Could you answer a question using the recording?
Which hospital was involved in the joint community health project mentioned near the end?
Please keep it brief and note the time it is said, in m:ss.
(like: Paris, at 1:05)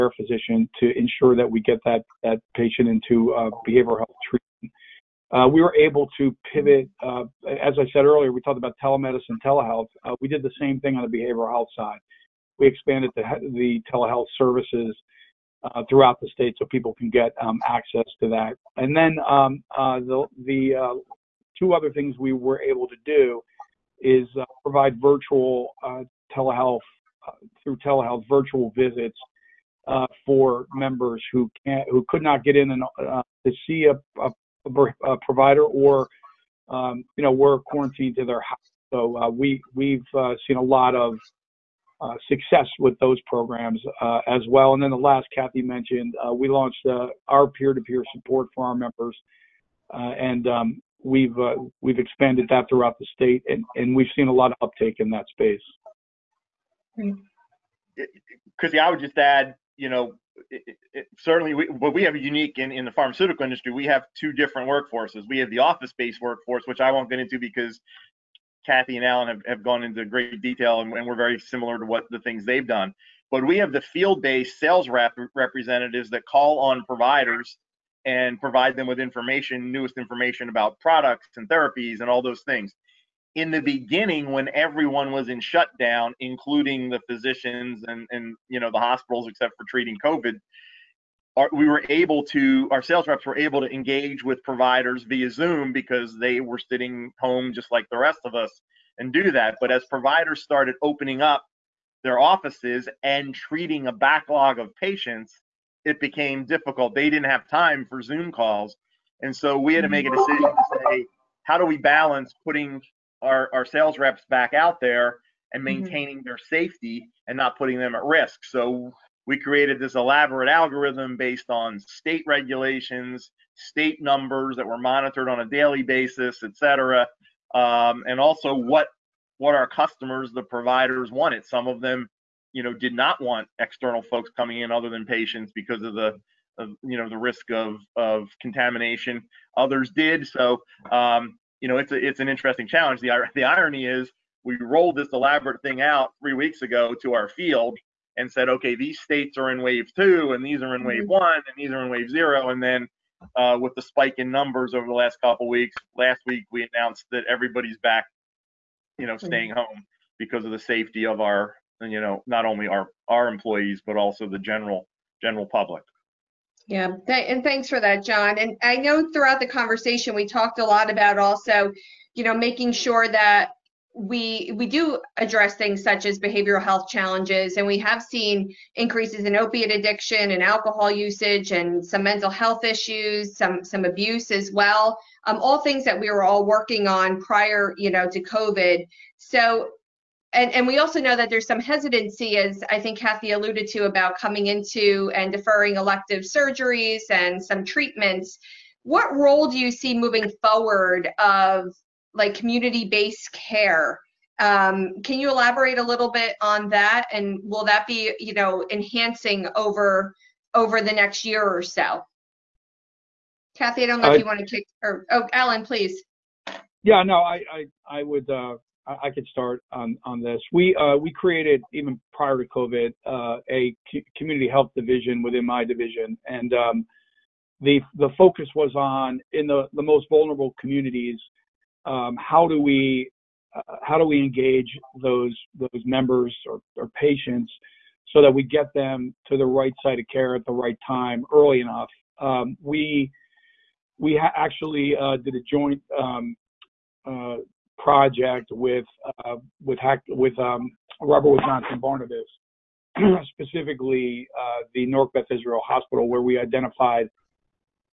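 Beth Israel Hospital, at 4:15.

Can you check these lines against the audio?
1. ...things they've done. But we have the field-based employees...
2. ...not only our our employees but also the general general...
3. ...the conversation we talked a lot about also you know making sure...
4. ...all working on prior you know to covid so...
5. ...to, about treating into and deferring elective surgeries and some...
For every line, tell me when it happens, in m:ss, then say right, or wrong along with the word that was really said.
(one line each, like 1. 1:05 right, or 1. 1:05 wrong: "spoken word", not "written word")
1. 1:12 wrong: "sales", not "employees"
2. 2:42 right
3. 2:49 right
4. 3:06 right
5. 3:13 wrong: "coming", not "treating".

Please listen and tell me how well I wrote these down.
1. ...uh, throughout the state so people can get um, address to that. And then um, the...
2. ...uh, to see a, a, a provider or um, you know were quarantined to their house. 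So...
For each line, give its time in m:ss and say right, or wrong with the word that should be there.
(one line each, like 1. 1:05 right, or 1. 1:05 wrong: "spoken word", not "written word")
1. 0:15 wrong: "access", not "address"
2. 0:33 right.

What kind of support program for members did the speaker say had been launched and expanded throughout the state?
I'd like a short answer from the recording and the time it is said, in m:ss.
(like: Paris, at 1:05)
peer-to-peer support, at 0:47.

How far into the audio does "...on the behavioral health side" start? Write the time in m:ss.
0:10.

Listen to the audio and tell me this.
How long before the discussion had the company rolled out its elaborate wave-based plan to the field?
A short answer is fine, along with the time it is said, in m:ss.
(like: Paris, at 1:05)
three weeks ago, at 2:26.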